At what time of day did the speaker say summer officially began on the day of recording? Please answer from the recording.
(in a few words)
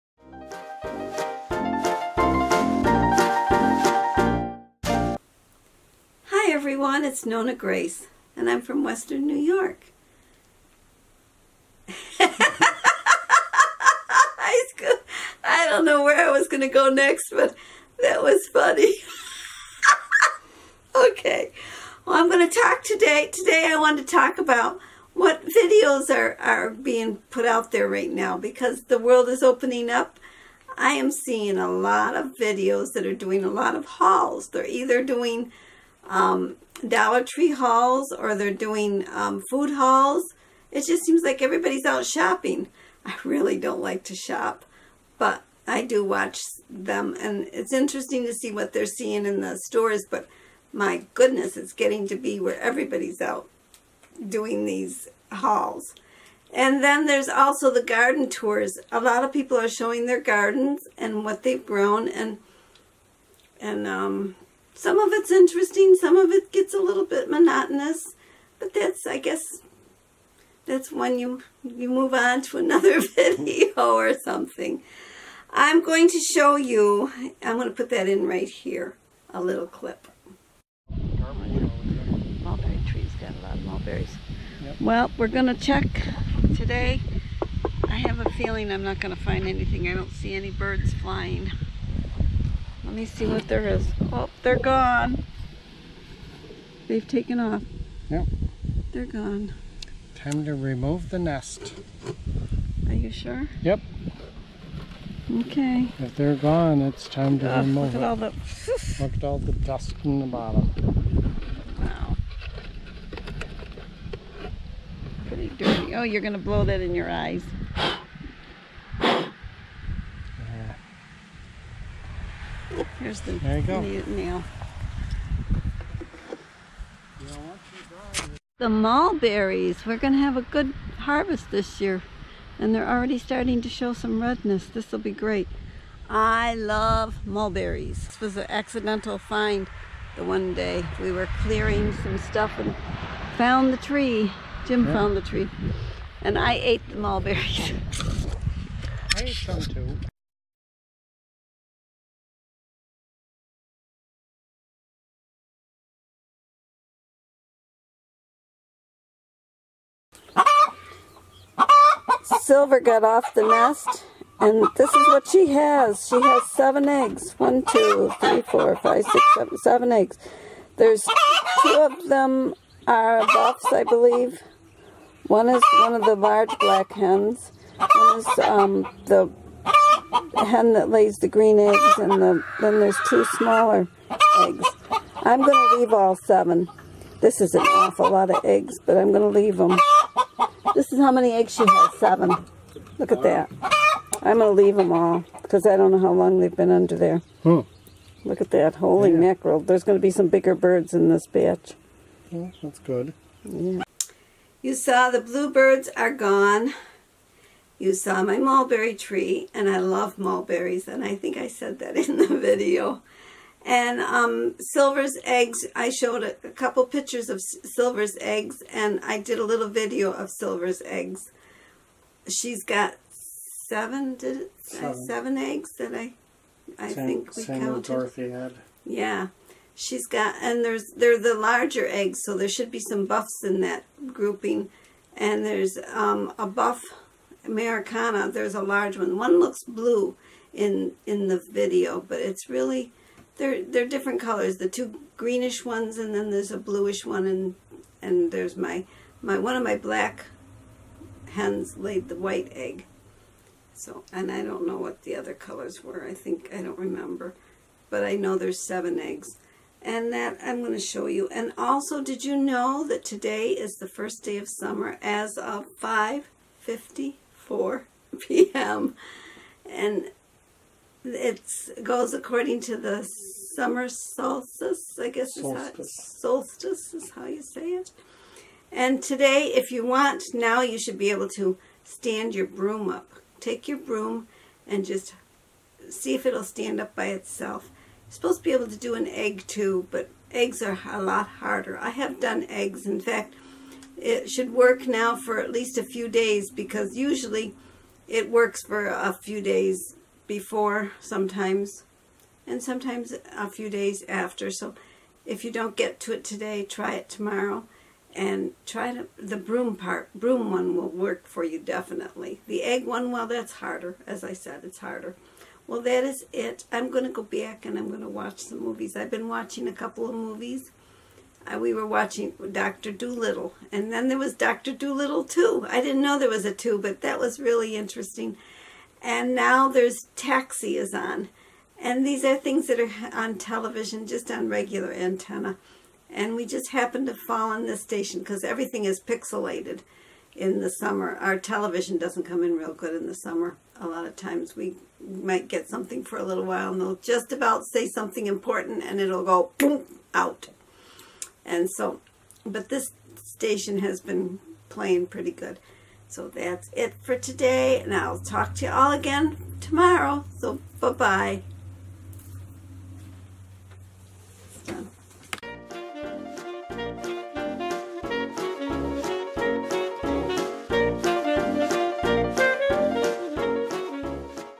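5:54 p.m.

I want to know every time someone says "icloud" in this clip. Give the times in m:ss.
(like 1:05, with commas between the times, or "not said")
not said.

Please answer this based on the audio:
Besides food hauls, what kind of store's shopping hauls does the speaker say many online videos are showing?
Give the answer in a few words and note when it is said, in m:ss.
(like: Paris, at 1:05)
Dollar Tree, at 0:36.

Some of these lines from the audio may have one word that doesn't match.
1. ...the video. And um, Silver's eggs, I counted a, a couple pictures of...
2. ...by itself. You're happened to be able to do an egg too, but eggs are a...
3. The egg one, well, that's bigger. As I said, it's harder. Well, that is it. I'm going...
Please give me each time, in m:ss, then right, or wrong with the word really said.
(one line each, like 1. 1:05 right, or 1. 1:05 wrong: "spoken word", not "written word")
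1. 3:32 wrong: "showed", not "counted"
2. 4:46 wrong: "supposed", not "happened"
3. 5:12 wrong: "harder", not "bigger".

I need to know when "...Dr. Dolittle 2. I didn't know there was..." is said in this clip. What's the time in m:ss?
5:24.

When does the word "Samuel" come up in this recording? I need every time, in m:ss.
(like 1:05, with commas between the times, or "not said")
3:47.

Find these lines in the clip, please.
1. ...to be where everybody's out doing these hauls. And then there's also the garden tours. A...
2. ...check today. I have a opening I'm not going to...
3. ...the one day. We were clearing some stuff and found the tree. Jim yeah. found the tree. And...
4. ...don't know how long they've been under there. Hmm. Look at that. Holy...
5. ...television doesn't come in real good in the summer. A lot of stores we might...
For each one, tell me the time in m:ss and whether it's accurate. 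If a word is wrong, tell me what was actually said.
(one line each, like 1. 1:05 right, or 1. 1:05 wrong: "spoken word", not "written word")
1. 0:52 right
2. 1:25 wrong: "feeling", not "opening"
3. 2:20 right
4. 3:15 right
5. 5:41 wrong: "times", not "stores".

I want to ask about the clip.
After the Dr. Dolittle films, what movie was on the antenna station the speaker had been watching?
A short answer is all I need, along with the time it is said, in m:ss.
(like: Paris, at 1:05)
Taxi, at 5:30.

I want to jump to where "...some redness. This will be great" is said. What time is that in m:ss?
2:13.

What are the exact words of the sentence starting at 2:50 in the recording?
There's two of them are buffs, I believe.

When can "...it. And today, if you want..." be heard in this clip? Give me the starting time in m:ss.
4:37.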